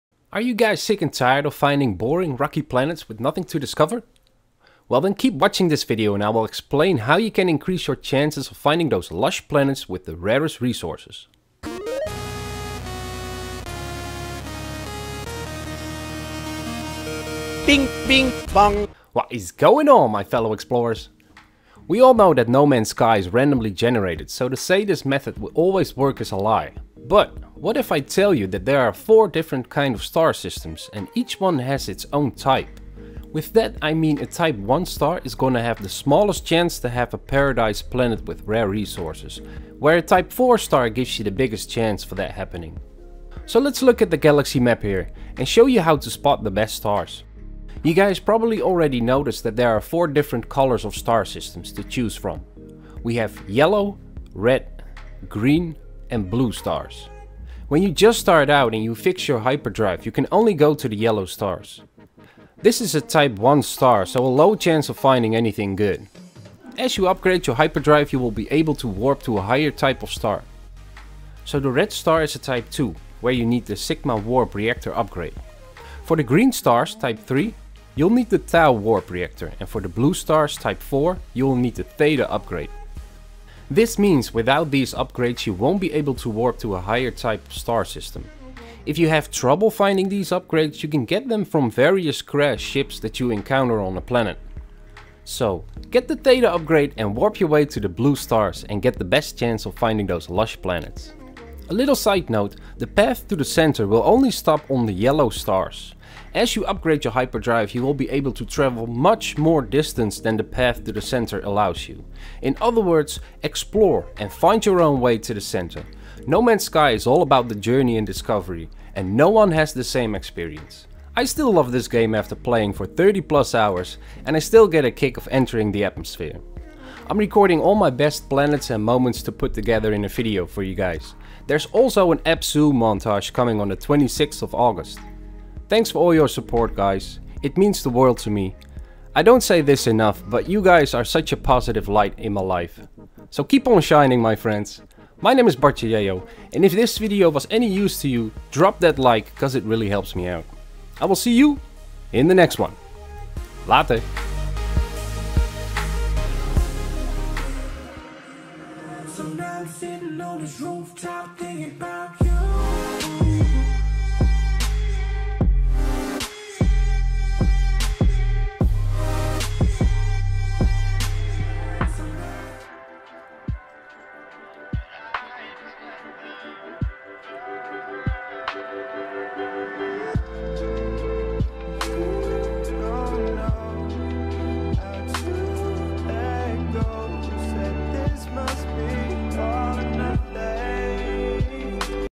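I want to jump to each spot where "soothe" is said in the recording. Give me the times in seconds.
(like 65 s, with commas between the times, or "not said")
not said.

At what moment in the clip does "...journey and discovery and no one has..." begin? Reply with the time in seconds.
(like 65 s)
117 s.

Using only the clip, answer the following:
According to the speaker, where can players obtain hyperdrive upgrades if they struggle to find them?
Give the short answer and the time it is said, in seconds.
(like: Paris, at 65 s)
Crash ships, at 92 s.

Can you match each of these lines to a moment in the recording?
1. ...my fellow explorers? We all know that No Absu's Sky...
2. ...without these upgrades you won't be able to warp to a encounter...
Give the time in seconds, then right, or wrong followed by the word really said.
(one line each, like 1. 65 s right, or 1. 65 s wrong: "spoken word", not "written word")
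1. 20 s wrong: "Man", not "Absu"
2. 84 s wrong: "higher", not "encounter".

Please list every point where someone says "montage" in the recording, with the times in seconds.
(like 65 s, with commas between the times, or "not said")
132 s.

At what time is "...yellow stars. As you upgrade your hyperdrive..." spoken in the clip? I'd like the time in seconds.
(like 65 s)
104 s.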